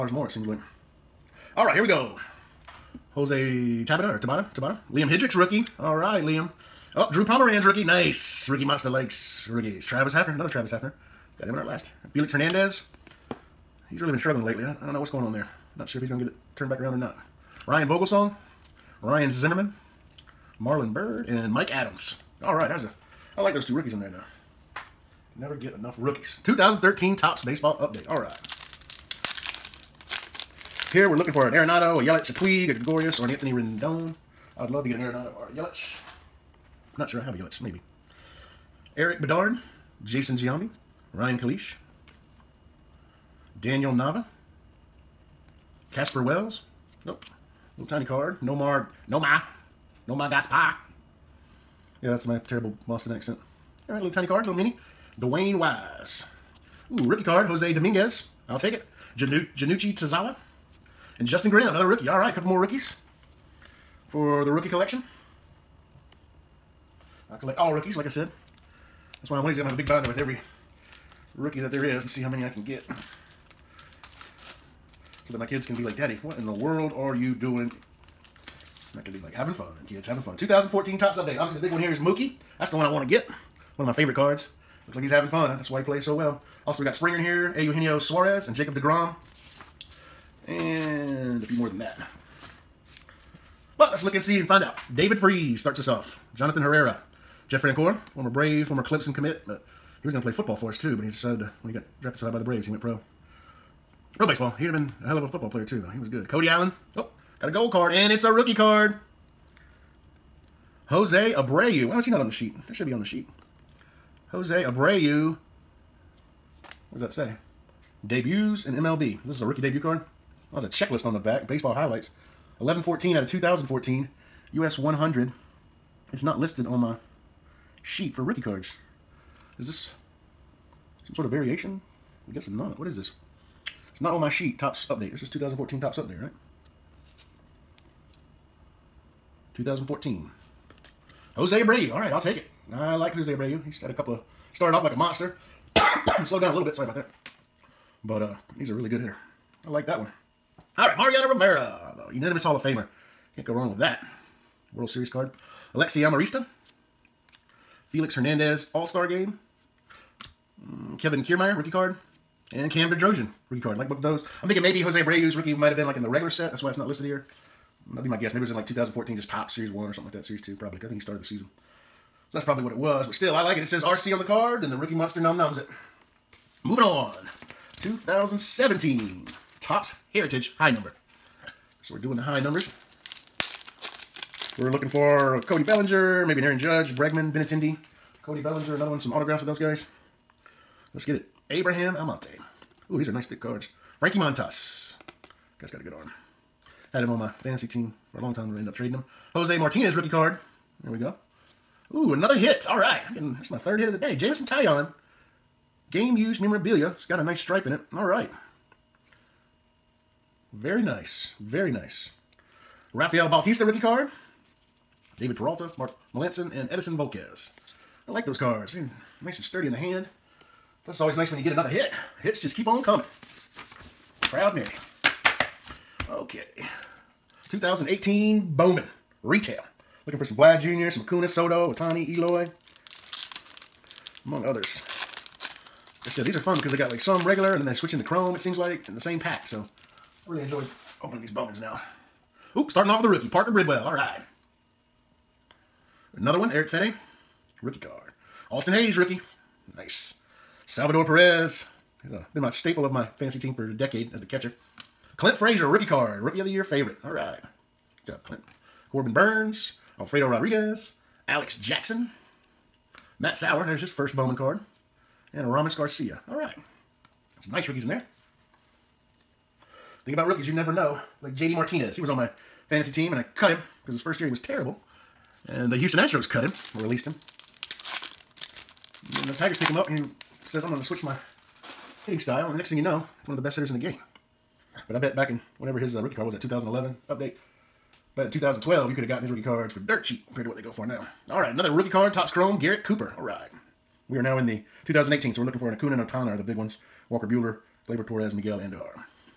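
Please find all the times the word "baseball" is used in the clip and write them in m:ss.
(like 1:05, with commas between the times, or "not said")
0:27, 1:44, 2:01.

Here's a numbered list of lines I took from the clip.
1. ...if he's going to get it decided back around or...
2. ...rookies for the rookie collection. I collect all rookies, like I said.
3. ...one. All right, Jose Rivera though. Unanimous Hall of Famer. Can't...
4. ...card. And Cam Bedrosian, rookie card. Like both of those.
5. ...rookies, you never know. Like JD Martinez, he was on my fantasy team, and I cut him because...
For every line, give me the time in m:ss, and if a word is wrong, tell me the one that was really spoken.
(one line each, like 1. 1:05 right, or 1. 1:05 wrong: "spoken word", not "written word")
1. 0:15 wrong: "turned", not "decided"
2. 1:02 right
3. 2:29 wrong: "Mariano", not "Jose"
4. 2:41 right
5. 4:30 right.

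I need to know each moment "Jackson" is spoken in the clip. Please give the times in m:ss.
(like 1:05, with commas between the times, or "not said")
4:21.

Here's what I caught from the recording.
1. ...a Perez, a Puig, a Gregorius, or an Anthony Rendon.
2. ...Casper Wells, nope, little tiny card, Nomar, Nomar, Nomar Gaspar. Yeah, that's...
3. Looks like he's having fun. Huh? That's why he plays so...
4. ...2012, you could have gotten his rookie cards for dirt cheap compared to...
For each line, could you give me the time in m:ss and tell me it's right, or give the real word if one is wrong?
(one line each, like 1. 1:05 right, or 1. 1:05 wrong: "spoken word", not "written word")
1. 0:31 wrong: "Yelich", not "Perez"
2. 0:45 right
3. 1:24 right
4. 4:48 right.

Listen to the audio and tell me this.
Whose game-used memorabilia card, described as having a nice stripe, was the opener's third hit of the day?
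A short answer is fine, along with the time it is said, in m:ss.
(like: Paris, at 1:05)
Jameson Taillon, at 3:24.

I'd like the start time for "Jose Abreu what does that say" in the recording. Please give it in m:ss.
1:54.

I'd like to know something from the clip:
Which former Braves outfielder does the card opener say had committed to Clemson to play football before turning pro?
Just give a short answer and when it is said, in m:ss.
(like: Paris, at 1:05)
Jeff Francoeur, at 1:37.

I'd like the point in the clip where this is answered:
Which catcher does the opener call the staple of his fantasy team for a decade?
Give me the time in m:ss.
4:10.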